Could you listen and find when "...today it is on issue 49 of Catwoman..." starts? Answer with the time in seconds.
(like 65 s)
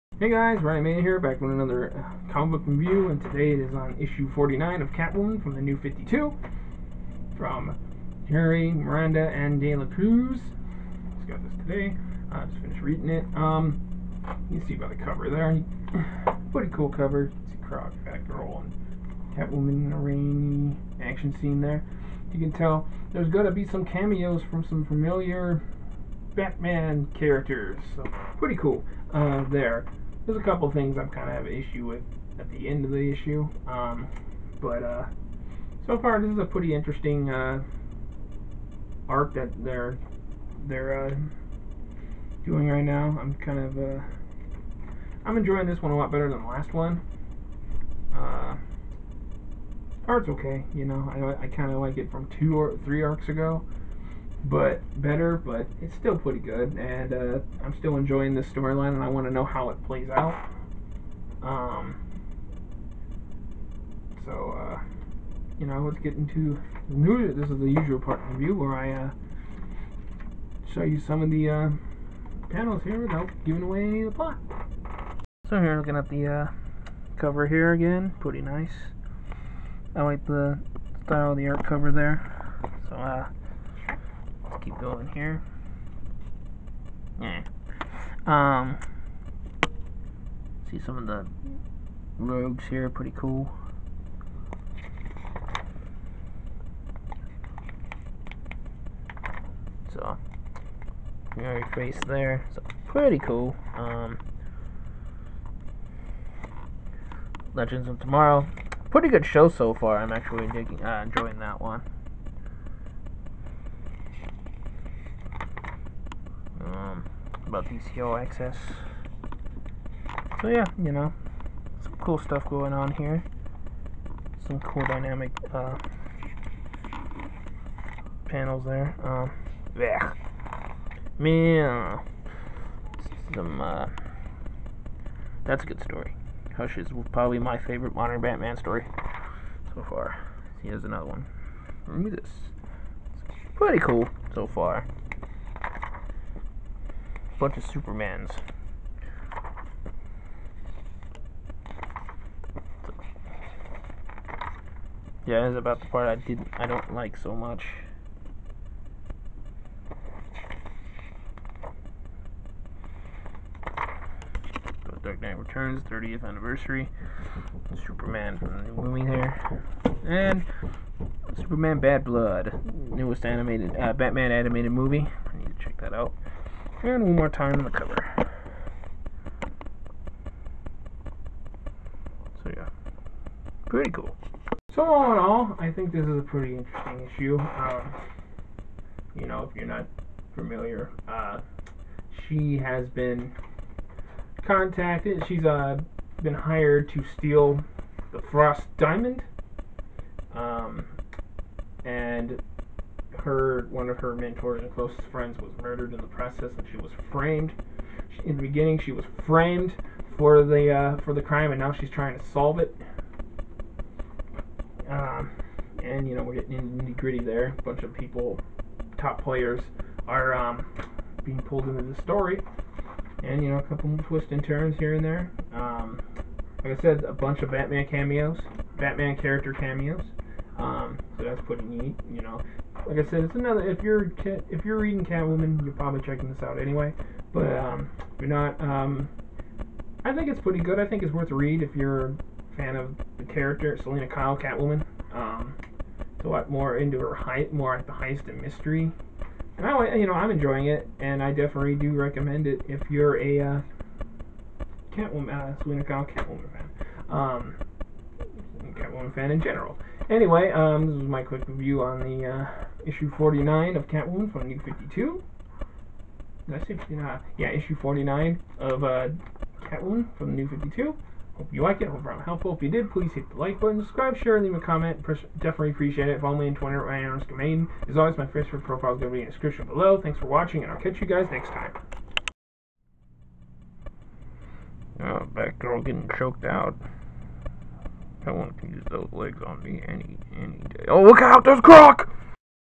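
3 s.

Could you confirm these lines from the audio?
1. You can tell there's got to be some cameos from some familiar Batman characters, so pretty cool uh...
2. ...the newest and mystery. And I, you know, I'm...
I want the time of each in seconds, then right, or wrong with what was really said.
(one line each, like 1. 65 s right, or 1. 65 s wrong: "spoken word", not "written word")
1. 22 s right
2. 247 s wrong: "heist", not "newest".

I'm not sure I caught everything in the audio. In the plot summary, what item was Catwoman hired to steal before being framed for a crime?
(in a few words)
The Frost Diamond.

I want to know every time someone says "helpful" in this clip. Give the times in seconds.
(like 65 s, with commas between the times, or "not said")
272 s.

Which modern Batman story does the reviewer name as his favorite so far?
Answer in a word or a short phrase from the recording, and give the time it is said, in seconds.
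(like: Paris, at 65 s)
Hush, at 136 s.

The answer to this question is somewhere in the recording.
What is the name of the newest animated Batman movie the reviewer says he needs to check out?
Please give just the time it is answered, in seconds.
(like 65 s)
171 s.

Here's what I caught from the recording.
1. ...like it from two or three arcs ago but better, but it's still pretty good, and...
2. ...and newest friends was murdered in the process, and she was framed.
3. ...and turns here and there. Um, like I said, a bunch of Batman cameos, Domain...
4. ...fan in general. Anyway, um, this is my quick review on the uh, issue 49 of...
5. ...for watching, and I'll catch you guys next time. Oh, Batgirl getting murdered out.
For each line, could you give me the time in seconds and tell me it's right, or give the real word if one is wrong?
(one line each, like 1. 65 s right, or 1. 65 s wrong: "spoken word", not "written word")
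1. 51 s right
2. 204 s wrong: "closest", not "newest"
3. 224 s wrong: "Batman", not "Domain"
4. 259 s right
5. 280 s wrong: "choked", not "murdered".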